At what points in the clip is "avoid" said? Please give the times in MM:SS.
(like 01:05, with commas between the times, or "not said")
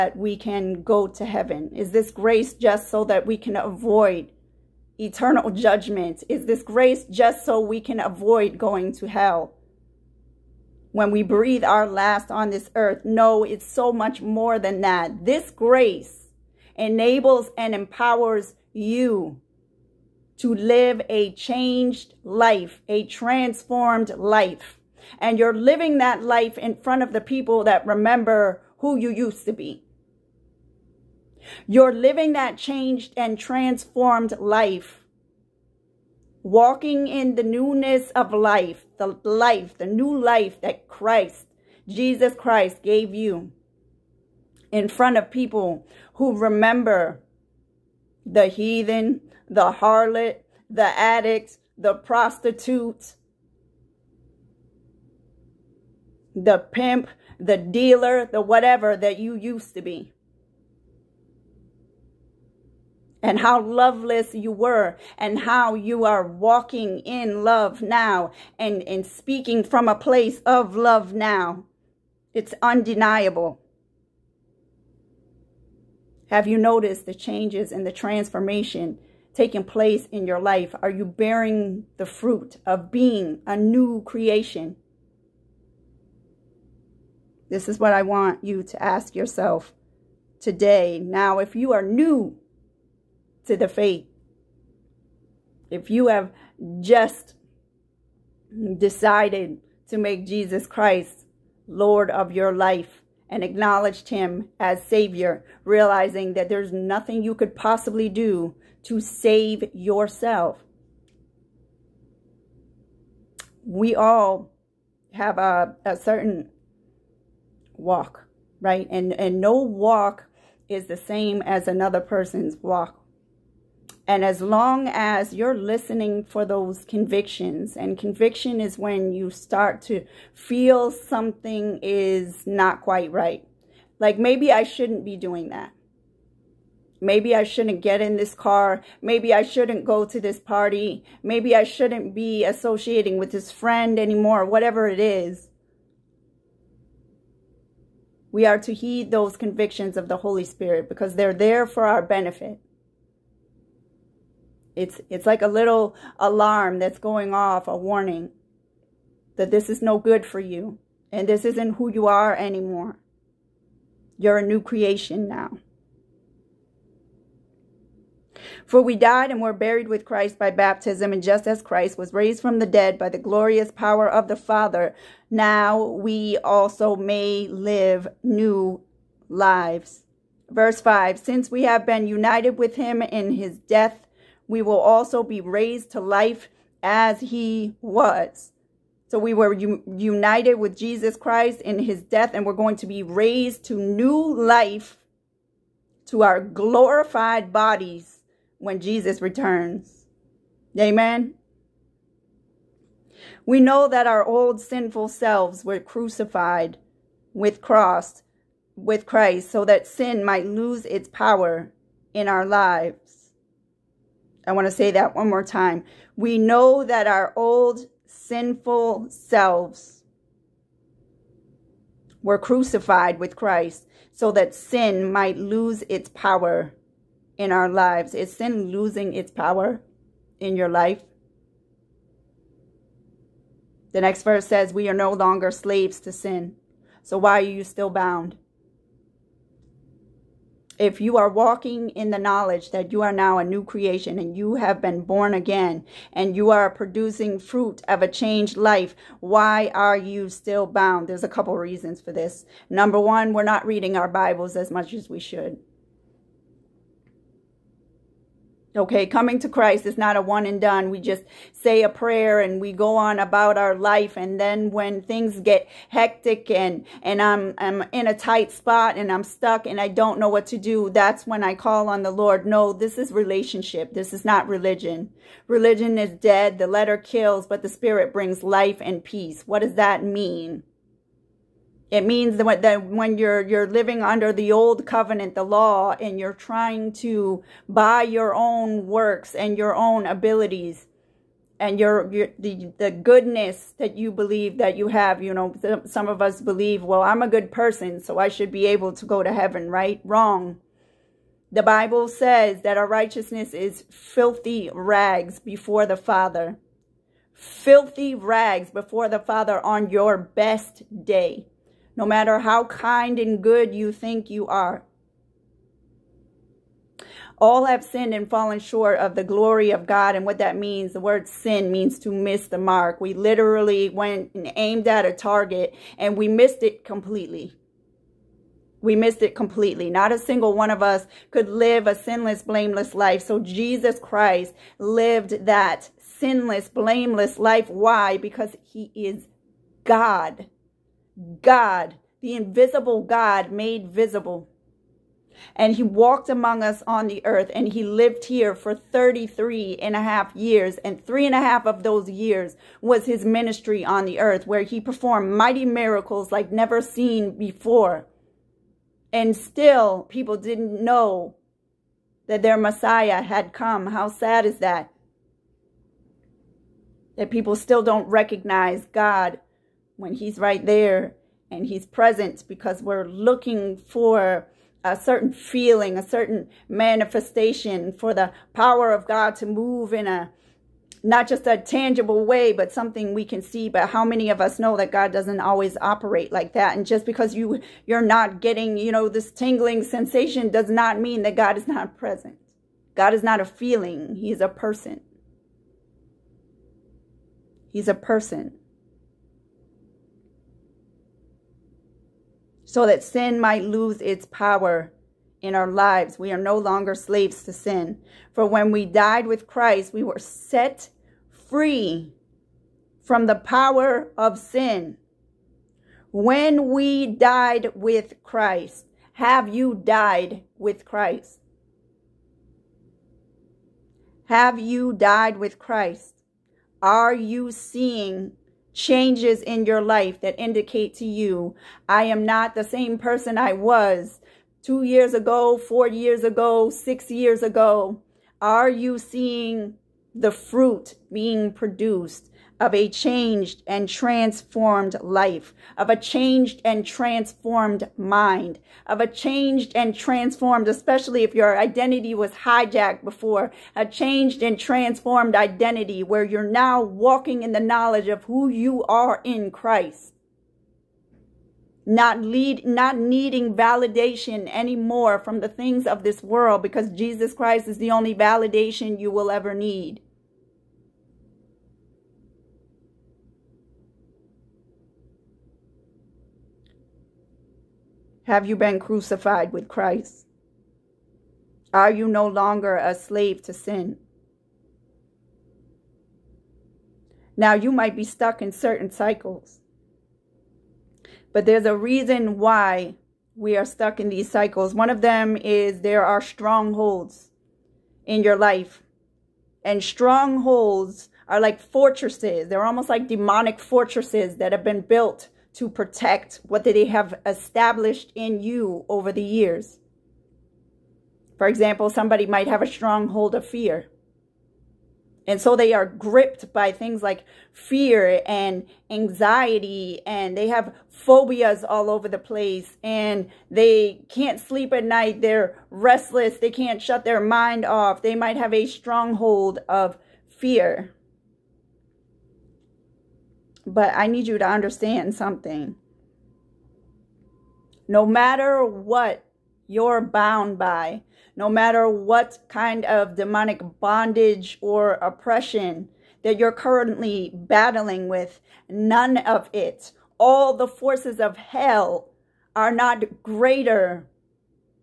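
00:03, 00:07.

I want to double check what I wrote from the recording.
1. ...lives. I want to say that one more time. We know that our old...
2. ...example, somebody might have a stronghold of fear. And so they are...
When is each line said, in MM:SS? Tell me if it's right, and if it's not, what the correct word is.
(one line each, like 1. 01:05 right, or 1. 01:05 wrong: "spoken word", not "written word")
1. 03:32 right
2. 08:31 right.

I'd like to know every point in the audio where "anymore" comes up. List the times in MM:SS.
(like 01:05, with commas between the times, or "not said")
02:23, 02:42, 07:44.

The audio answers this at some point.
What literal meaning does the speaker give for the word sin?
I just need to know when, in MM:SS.
05:21.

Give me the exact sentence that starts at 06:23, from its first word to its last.
But how many of us know that God doesn't always operate like that?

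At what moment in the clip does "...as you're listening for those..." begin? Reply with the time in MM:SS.
02:04.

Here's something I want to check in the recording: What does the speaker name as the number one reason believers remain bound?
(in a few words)
not reading our Bibles.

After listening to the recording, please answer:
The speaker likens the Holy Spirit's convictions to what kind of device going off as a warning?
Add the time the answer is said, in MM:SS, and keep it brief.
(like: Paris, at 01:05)
a little alarm, at 02:35.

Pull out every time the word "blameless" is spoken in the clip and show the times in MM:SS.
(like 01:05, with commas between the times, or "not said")
05:32, 05:36.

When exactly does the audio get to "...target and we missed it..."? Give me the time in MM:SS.
05:25.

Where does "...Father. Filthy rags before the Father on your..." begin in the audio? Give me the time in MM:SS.
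05:05.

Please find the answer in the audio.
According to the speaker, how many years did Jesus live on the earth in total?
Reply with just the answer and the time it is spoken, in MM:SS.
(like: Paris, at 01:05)
33.5, at 05:48.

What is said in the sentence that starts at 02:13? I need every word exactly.
Like maybe I shouldn't be doing that.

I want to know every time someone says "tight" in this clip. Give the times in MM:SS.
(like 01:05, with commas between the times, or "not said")
04:28.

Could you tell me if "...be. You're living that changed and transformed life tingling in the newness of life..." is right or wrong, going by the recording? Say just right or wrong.
wrong.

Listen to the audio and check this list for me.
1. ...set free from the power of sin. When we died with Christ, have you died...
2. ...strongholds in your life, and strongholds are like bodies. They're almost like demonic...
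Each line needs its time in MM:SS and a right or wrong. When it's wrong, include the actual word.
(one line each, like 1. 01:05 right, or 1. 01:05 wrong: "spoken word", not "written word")
1. 06:50 right
2. 08:16 wrong: "fortresses", not "bodies".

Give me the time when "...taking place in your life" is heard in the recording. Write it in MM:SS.
01:19.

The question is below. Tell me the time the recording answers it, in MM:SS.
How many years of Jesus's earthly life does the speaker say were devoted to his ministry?
05:51.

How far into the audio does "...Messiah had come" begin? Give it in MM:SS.
06:02.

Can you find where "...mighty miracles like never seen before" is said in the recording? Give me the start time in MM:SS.
05:55.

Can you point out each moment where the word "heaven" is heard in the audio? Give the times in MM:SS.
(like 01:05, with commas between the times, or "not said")
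00:01, 04:59.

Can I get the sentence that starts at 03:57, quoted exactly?
So why are you still bound?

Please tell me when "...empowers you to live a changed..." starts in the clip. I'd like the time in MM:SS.
00:17.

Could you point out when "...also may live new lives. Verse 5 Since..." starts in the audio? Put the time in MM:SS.
02:56.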